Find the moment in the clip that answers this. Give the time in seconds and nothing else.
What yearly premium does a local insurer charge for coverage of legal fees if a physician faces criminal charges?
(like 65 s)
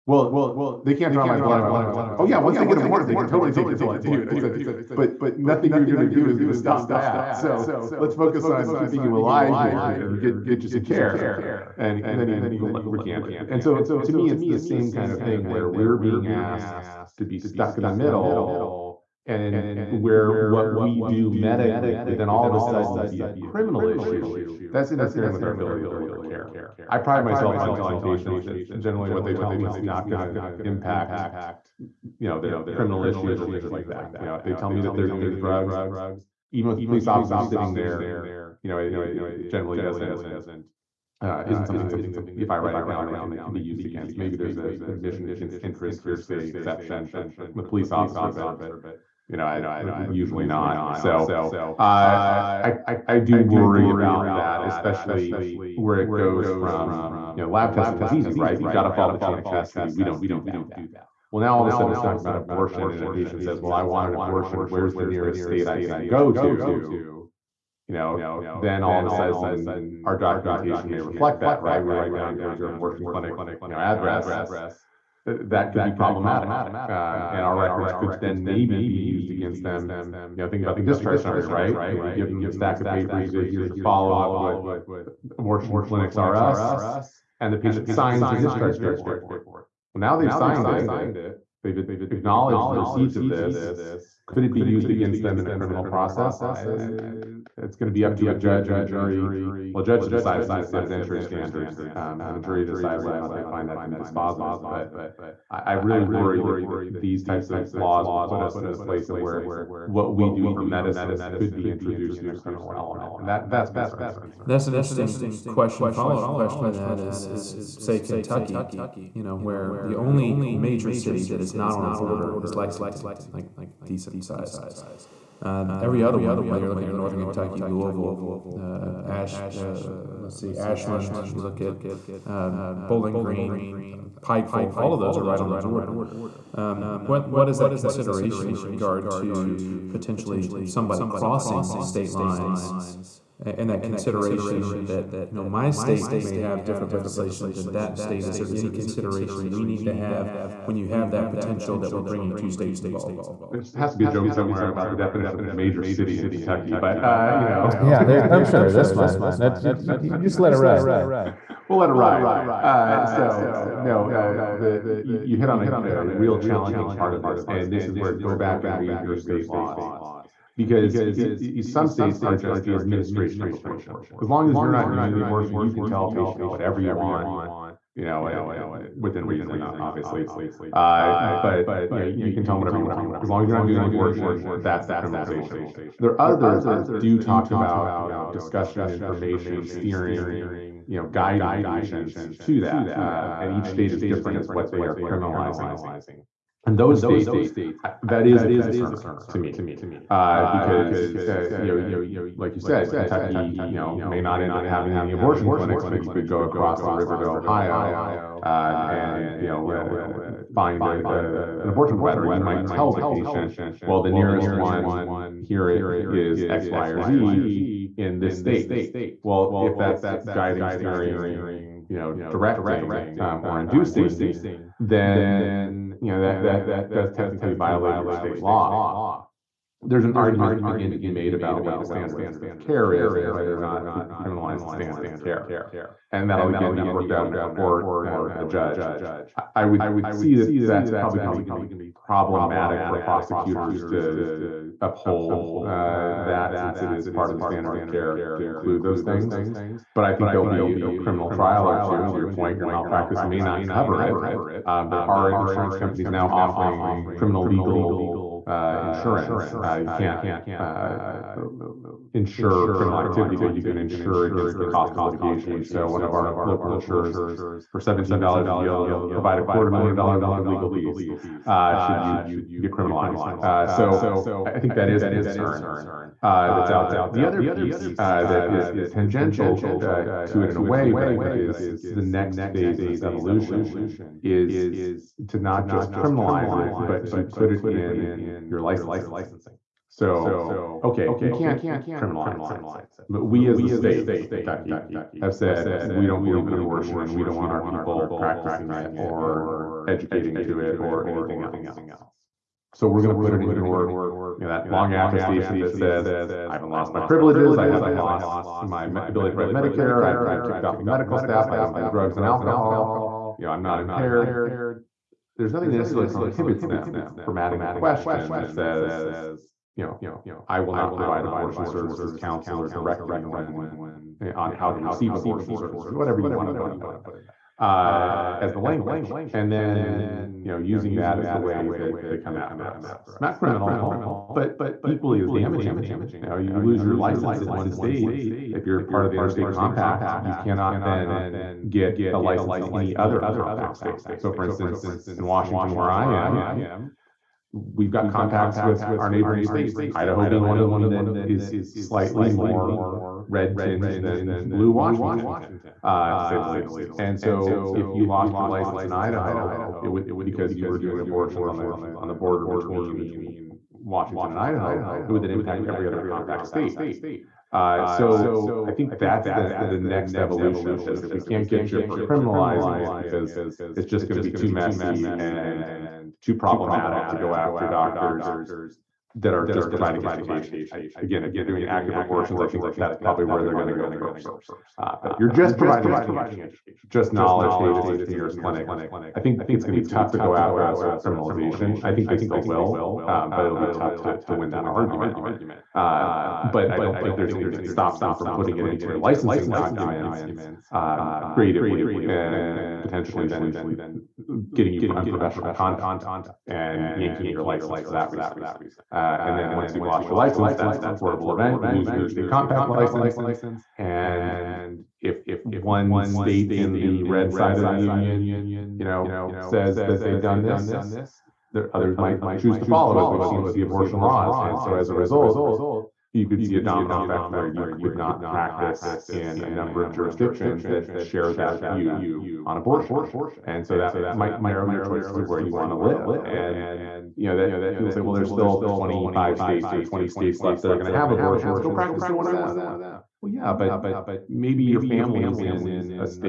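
267 s.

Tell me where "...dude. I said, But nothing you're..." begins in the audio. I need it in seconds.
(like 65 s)
4 s.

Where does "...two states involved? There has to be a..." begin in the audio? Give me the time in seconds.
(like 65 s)
152 s.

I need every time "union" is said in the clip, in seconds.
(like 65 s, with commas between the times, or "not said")
417 s.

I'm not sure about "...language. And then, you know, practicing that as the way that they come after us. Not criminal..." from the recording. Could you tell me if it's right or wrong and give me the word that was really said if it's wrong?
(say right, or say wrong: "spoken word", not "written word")
wrong: "using", not "practicing".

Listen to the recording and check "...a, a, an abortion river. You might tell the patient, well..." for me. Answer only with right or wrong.
wrong.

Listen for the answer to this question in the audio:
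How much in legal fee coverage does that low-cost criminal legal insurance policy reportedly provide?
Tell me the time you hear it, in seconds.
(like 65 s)
269 s.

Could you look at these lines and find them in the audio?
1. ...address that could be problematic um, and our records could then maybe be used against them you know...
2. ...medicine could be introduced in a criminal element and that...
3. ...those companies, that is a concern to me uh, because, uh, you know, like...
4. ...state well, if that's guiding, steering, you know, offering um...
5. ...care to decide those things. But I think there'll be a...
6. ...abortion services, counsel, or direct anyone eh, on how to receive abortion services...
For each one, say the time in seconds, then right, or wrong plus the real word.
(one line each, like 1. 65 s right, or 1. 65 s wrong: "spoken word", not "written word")
1. 73 s right
2. 110 s right
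3. 196 s wrong: "states", not "companies"
4. 218 s wrong: "directing", not "offering"
5. 247 s wrong: "include", not "decide"
6. 321 s right.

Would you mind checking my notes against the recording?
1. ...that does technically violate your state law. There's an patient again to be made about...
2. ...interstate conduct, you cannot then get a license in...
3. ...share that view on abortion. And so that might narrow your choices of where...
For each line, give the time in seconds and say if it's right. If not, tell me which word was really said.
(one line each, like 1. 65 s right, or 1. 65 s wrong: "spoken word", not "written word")
1. 226 s wrong: "argument", not "patient"
2. 339 s wrong: "compact", not "conduct"
3. 430 s right.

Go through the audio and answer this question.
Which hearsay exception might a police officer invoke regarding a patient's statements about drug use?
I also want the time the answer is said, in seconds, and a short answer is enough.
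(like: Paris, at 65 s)
admission against interest, at 44 s.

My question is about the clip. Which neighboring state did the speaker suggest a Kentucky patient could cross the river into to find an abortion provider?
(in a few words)
Ohio.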